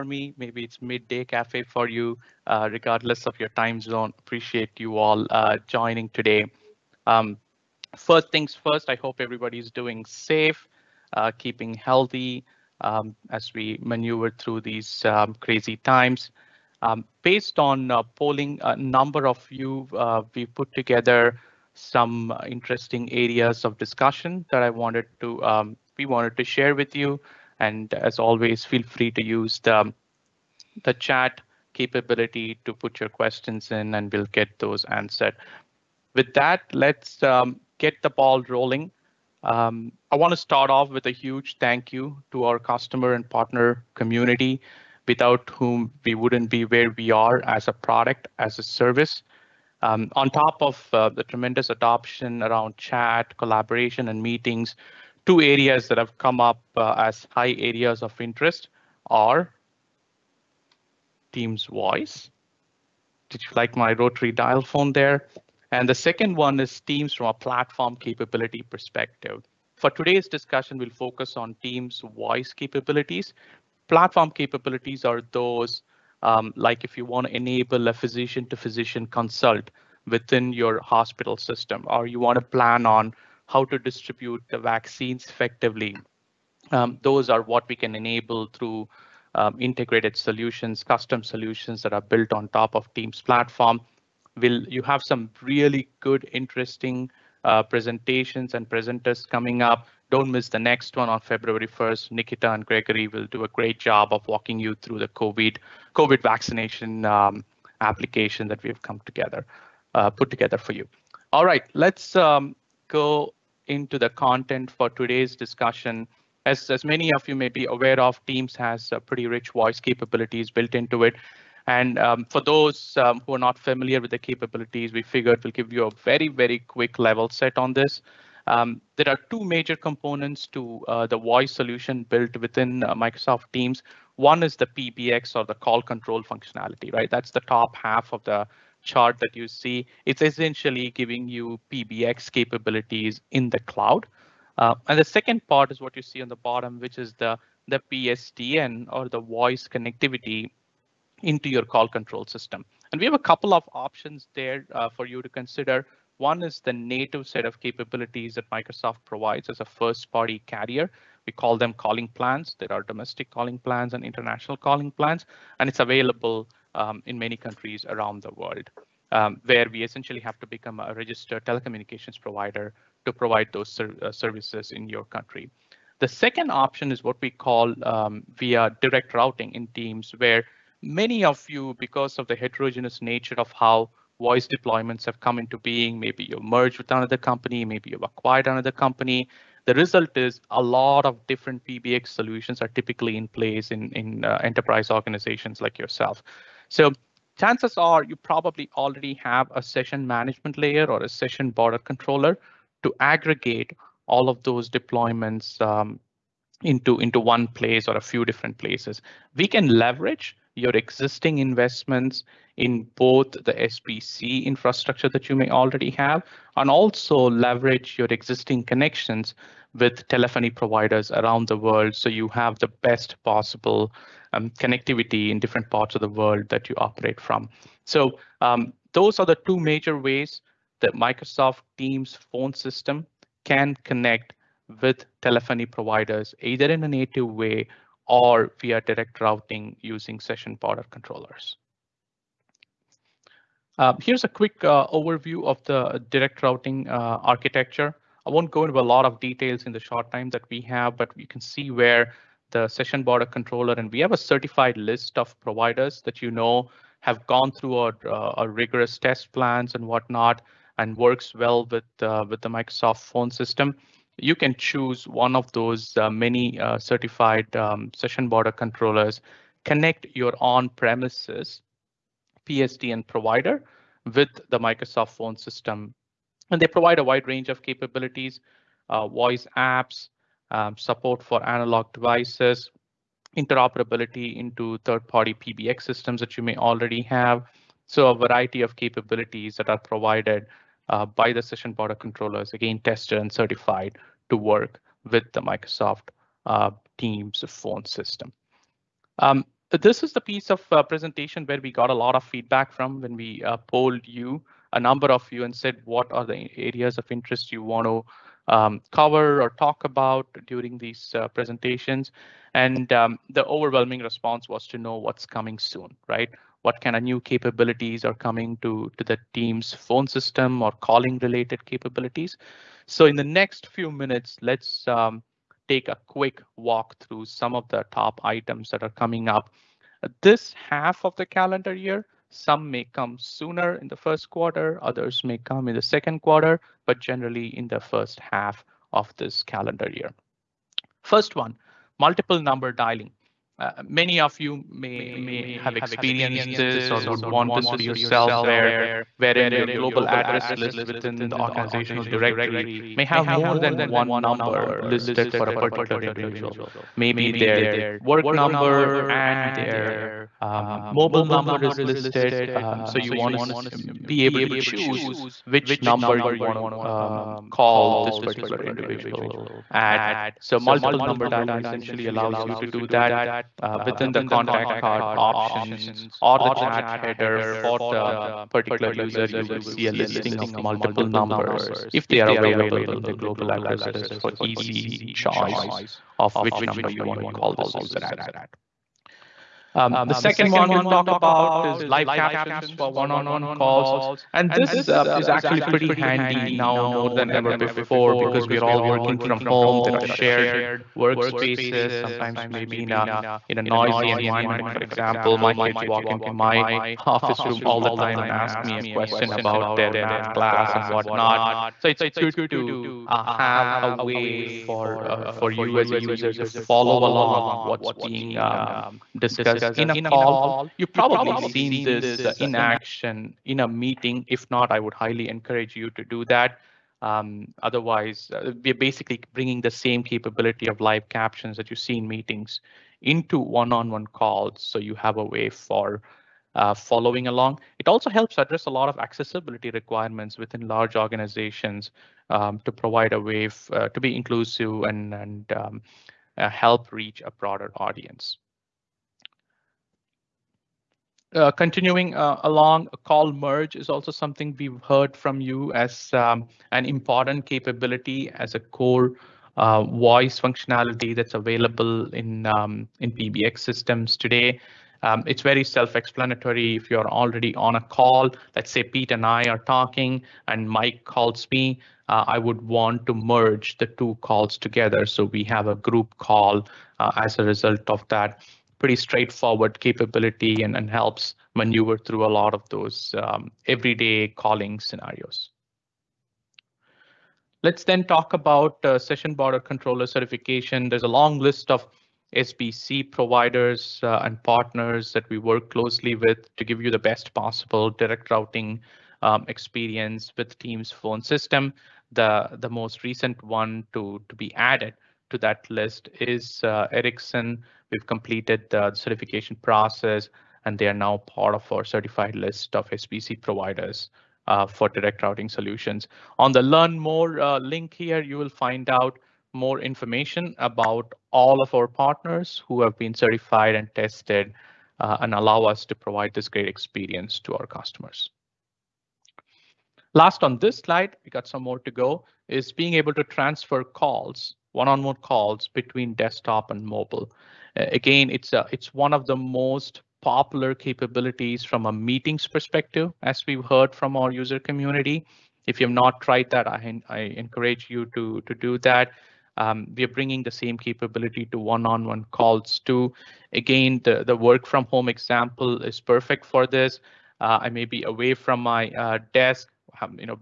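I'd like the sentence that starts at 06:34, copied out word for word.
And this uh, is actually pretty handy now more than ever before because we are all working from home.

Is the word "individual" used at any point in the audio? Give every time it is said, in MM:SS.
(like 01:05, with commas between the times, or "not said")
05:56, 06:08.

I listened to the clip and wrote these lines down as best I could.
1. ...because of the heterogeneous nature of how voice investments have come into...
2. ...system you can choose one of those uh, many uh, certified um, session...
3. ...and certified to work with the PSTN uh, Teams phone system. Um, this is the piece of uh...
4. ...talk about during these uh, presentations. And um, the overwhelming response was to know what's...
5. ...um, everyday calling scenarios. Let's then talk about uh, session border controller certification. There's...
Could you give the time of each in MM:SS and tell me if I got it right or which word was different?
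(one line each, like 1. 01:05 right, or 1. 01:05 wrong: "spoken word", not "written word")
1. 03:01 wrong: "deployments", not "investments"
2. 04:23 right
3. 04:53 wrong: "Microsoft", not "PSTN"
4. 05:09 right
5. 08:03 right.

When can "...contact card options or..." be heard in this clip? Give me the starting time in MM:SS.
06:14.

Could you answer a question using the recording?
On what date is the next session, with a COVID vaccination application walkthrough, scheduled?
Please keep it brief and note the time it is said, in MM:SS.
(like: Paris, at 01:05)
February 1st, at 01:41.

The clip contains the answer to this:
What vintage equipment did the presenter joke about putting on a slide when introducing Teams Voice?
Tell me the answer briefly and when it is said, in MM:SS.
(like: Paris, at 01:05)
Rotary dial phone, at 01:03.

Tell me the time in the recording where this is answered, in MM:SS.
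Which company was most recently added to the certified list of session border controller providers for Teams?
08:26.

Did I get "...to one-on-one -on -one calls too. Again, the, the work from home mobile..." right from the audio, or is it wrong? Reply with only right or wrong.
wrong.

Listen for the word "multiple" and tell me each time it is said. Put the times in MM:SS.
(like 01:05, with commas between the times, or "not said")
05:41, 06:10, 06:20.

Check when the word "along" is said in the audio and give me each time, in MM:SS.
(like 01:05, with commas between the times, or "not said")
06:57, 07:17, 07:32.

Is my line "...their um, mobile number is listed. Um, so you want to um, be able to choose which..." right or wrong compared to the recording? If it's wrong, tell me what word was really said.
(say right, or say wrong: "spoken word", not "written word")
right.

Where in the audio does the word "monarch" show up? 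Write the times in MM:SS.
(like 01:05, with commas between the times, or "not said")
not said.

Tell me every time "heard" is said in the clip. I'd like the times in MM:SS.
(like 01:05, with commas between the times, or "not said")
07:34, 09:03.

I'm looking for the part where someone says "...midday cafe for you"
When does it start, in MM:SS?
00:00.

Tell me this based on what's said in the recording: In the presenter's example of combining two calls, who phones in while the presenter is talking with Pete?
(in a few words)
Mike.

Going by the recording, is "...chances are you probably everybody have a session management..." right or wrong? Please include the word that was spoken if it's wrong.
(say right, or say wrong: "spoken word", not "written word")
wrong: "already", not "everybody".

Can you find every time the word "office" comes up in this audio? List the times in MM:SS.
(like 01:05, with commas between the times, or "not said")
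06:47.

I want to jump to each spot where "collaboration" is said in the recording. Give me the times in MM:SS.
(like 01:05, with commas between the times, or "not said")
00:53.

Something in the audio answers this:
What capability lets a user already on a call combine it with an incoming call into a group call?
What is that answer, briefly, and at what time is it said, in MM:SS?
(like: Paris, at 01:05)
Call merge, at 07:33.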